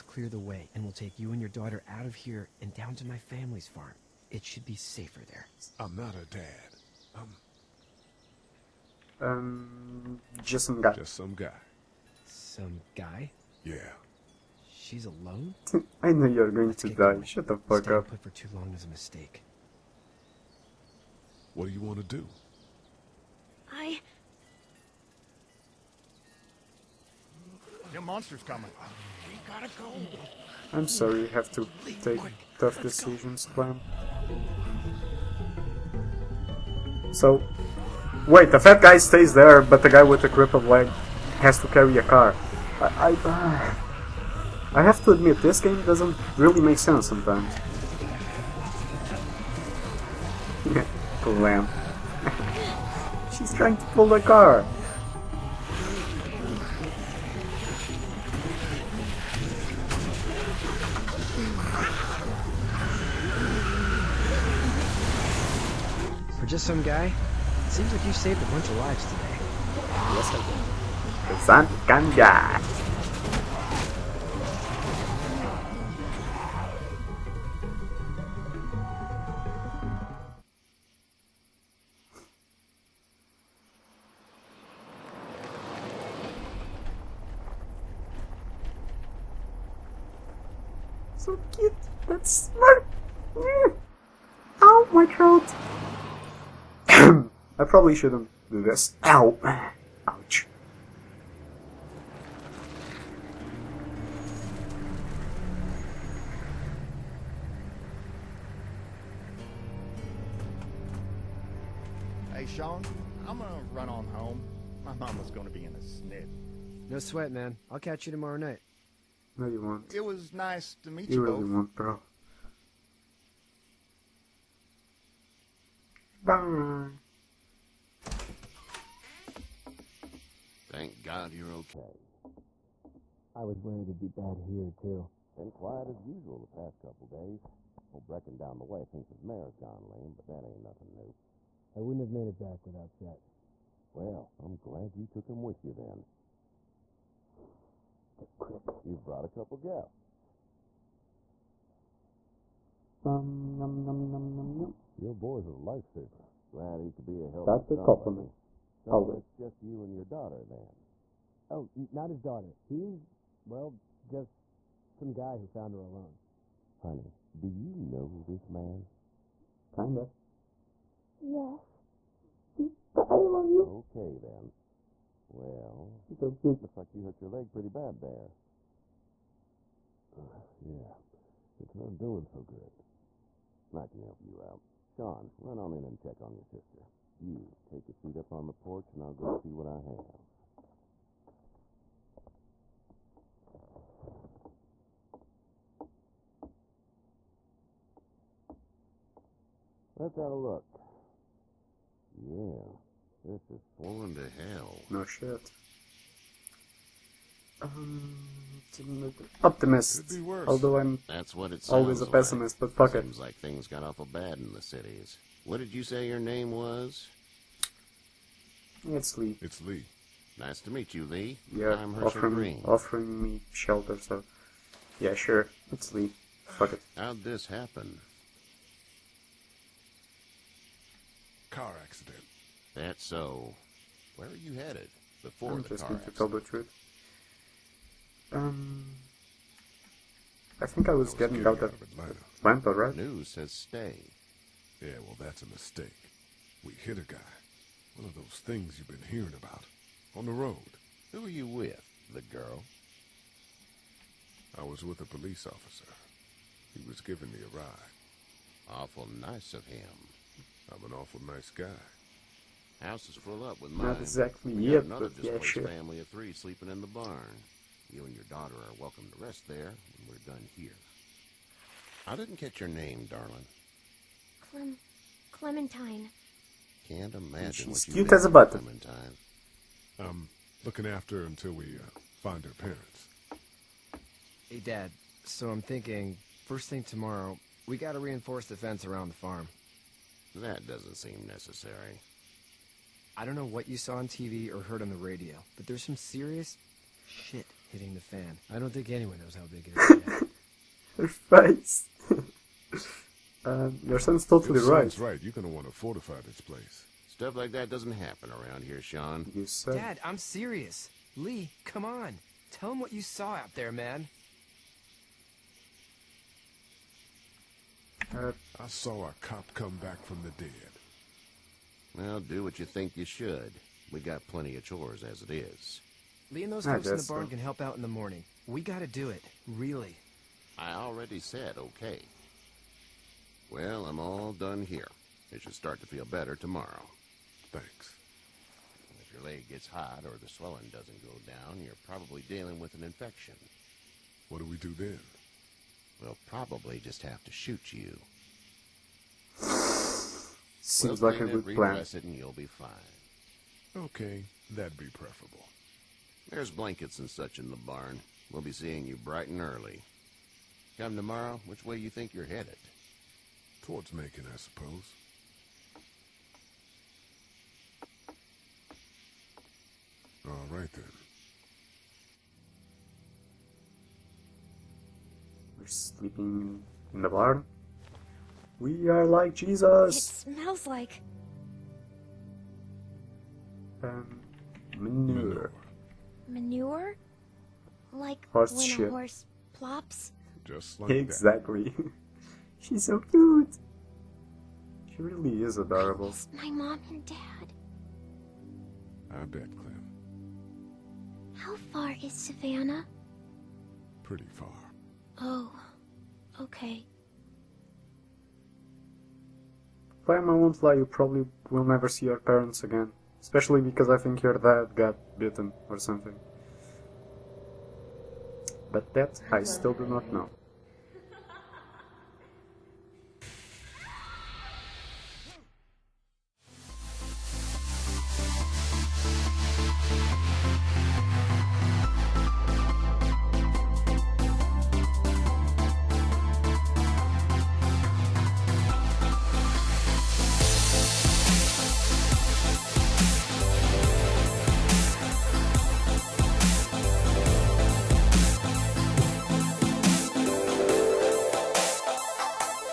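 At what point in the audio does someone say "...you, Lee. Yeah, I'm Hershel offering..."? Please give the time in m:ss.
3:40.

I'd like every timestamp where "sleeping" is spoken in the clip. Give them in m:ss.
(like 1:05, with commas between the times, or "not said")
4:26, 6:15.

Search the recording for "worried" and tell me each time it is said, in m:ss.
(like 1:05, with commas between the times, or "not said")
2:13.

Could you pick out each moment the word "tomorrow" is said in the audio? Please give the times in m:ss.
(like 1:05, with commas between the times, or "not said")
1:58, 4:46, 5:36, 6:00.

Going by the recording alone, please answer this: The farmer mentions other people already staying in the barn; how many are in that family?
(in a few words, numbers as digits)
3.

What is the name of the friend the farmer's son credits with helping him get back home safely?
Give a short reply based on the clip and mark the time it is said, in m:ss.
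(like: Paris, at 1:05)
Chet, at 2:22.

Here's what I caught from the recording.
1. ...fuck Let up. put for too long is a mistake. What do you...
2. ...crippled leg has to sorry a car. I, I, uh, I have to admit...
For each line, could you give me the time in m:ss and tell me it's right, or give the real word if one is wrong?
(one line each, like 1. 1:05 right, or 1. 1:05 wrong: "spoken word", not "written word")
1. 0:17 wrong: "Staying", not "Let"
2. 0:40 wrong: "carry", not "sorry".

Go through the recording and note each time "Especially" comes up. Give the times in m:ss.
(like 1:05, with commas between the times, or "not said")
6:53.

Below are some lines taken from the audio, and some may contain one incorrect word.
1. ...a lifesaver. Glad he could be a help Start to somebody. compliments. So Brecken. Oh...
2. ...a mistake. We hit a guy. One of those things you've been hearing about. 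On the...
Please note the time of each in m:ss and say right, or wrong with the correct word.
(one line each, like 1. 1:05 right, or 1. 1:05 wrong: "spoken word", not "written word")
1. 2:35 wrong: "Always", not "Brecken"
2. 4:05 right.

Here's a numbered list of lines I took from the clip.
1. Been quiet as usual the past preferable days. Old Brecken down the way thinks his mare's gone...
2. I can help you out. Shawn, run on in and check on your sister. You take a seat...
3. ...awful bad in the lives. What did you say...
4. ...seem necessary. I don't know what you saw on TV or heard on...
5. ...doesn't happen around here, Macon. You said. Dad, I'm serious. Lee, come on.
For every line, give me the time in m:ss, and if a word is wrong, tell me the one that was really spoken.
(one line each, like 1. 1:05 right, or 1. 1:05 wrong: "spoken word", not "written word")
1. 2:15 wrong: "couple", not "preferable"
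2. 3:03 right
3. 3:33 wrong: "cities", not "lives"
4. 4:50 right
5. 5:07 wrong: "Shawn", not "Macon".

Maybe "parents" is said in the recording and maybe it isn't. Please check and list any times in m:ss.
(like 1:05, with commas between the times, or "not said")
4:42, 6:52.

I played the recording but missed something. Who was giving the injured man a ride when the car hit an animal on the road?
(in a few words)
A police officer.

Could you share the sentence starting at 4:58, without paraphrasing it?
I don't think anyone knows how big it is.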